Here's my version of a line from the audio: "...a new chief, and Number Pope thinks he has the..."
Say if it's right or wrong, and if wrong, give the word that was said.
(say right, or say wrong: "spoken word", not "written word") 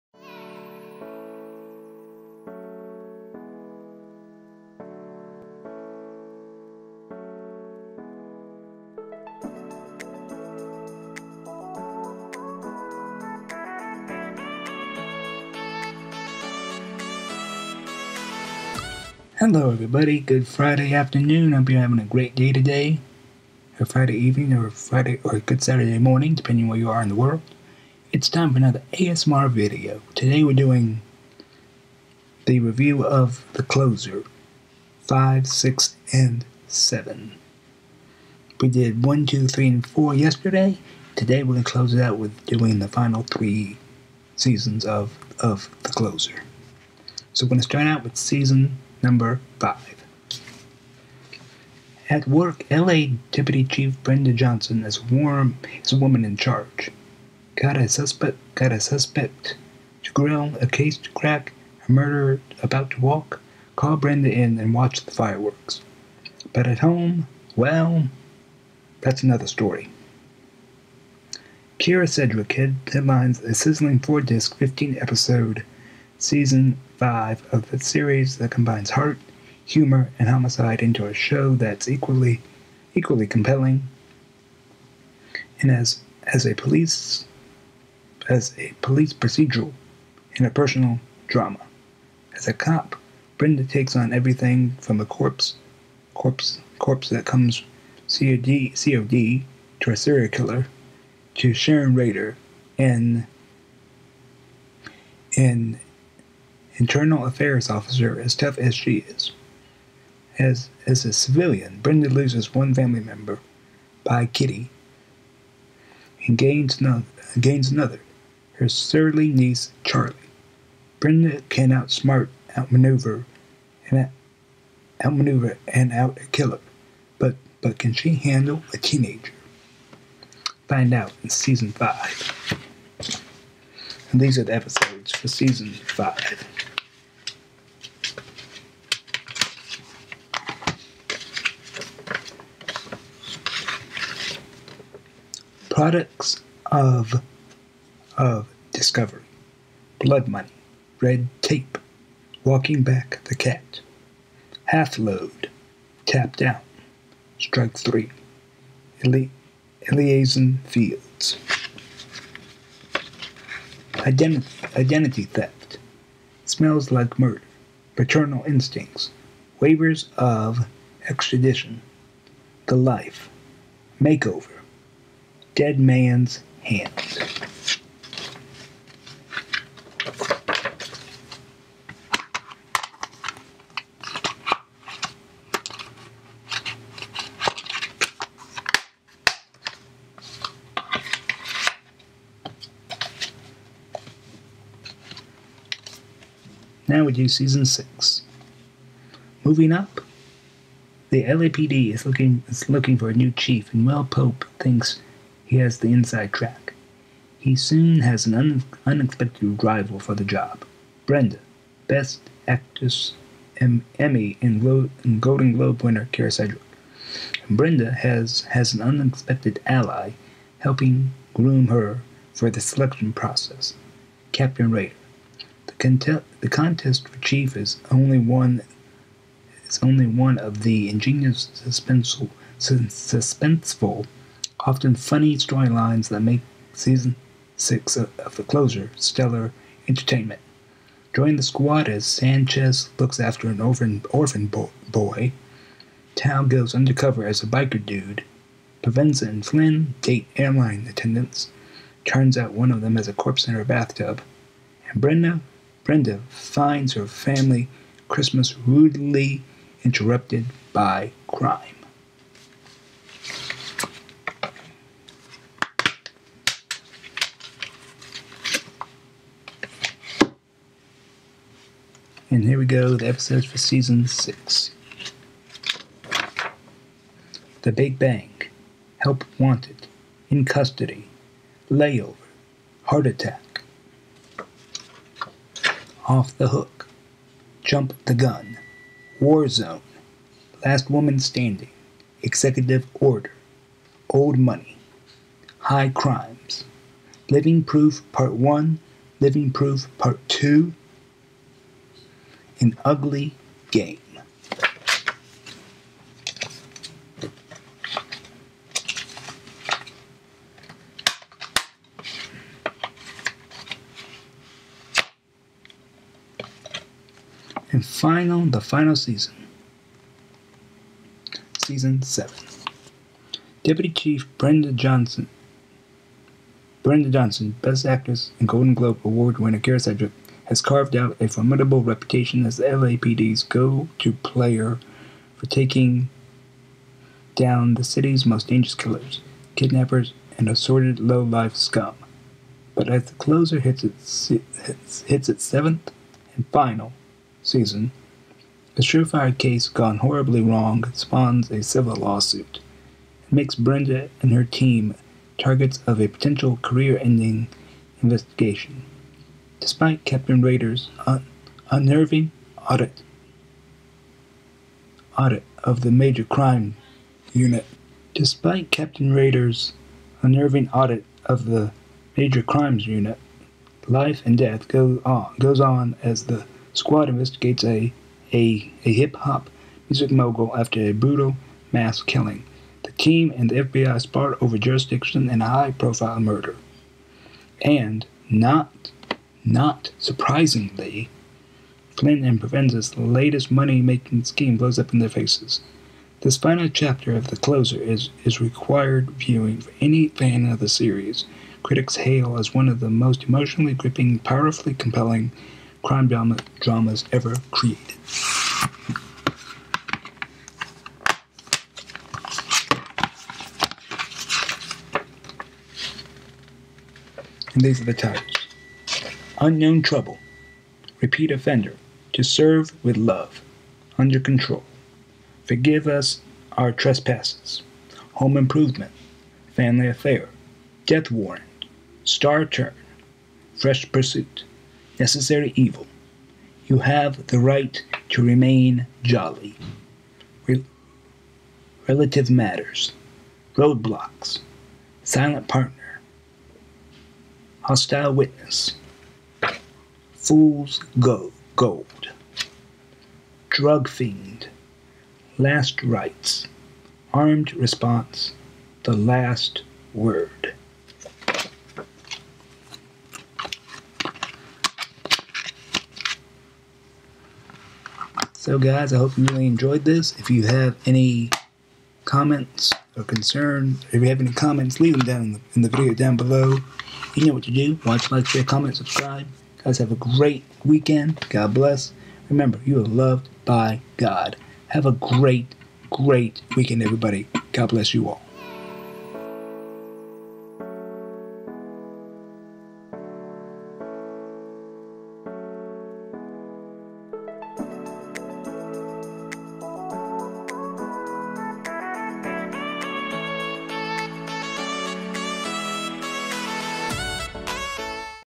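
wrong: "Will", not "Number".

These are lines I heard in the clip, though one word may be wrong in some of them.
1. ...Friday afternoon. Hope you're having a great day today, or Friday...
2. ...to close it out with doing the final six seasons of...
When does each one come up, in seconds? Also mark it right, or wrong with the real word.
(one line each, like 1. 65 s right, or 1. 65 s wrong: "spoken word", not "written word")
1. 20 s right
2. 41 s wrong: "three", not "six".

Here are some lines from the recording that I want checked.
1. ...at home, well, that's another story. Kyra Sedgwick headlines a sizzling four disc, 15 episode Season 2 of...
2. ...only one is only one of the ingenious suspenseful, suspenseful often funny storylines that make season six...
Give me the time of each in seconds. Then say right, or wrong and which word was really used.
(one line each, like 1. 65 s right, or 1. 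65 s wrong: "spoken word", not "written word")
1. 66 s wrong: "5", not "2"
2. 227 s right.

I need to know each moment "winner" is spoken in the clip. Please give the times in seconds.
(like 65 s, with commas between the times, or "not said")
215 s, 329 s.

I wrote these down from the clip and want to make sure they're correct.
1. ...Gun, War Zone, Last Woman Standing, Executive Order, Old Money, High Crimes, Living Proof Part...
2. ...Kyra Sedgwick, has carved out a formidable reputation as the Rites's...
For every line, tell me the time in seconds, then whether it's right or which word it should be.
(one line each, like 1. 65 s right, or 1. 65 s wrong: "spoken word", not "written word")
1. 288 s right
2. 329 s wrong: "LAPD", not "Rites".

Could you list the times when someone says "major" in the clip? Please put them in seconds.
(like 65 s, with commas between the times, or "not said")
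365 s, 372 s.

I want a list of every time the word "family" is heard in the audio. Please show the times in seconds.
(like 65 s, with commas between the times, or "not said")
112 s, 257 s, 429 s.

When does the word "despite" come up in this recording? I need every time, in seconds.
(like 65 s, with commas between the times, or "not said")
359 s, 368 s.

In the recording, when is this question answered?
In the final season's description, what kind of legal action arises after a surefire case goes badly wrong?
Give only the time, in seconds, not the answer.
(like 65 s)
351 s.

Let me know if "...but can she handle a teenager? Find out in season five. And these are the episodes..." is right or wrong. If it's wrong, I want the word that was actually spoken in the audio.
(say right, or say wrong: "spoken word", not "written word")
right.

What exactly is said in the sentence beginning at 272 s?
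And here we go, the episodes for season six.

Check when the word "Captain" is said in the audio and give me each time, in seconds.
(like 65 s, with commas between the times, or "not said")
224 s, 360 s, 368 s.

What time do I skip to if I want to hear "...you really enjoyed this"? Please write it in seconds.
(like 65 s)
469 s.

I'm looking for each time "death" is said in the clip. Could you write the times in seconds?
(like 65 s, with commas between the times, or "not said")
374 s, 430 s.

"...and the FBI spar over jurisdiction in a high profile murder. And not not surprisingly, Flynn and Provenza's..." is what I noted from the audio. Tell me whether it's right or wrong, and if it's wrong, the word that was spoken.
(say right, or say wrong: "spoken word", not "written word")
right.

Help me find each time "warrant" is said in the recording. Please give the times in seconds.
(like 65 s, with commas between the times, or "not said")
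431 s.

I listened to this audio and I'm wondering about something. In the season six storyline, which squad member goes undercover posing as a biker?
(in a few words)
Tao.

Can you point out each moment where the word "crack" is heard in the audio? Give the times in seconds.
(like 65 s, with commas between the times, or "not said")
61 s.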